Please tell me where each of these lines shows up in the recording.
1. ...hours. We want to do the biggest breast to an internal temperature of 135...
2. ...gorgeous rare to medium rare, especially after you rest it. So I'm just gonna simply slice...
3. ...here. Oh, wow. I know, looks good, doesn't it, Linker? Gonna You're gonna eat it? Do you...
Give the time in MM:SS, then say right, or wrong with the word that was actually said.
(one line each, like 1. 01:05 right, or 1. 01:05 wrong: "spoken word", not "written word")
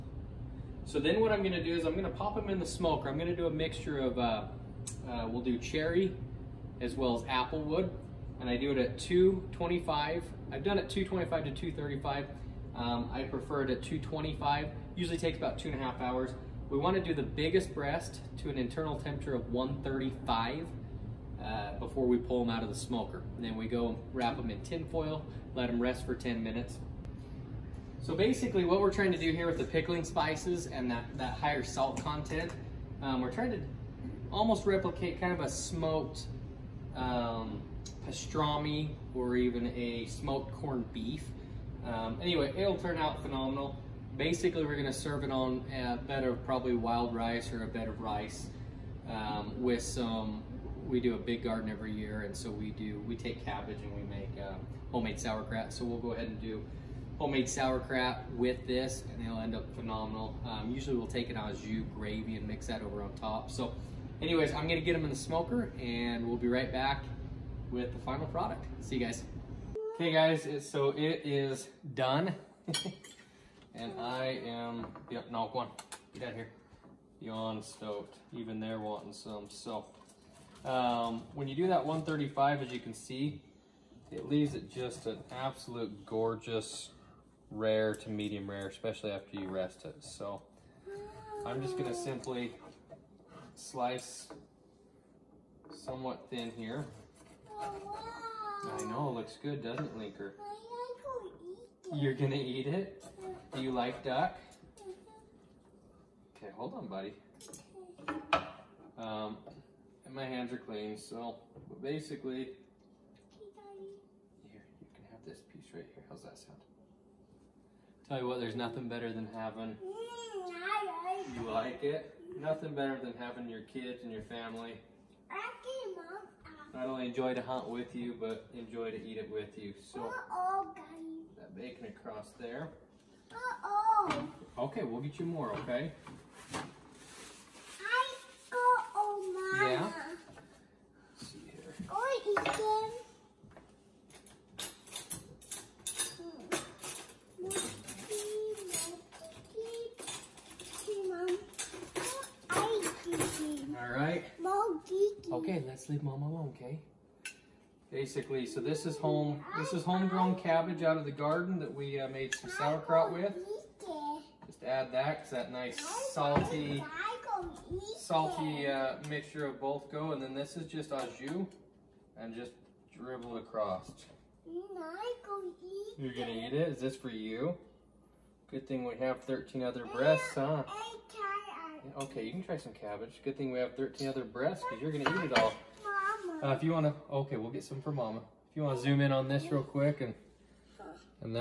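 1. 00:16 right
2. 01:26 right
3. 01:36 right.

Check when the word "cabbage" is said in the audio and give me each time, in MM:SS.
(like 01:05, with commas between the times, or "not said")
00:53, 02:40, 03:02.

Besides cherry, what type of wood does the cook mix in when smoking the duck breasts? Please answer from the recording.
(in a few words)
Applewood.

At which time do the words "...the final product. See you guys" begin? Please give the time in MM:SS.
01:07.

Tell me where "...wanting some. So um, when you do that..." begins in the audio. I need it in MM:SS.
01:18.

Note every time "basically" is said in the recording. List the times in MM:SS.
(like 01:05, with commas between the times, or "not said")
00:28, 00:44, 01:51, 02:37.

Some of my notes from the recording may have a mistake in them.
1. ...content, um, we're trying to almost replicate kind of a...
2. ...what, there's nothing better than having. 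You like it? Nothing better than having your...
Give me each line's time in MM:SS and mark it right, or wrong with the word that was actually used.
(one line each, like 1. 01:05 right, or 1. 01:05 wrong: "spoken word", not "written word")
1. 00:32 right
2. 01:58 right.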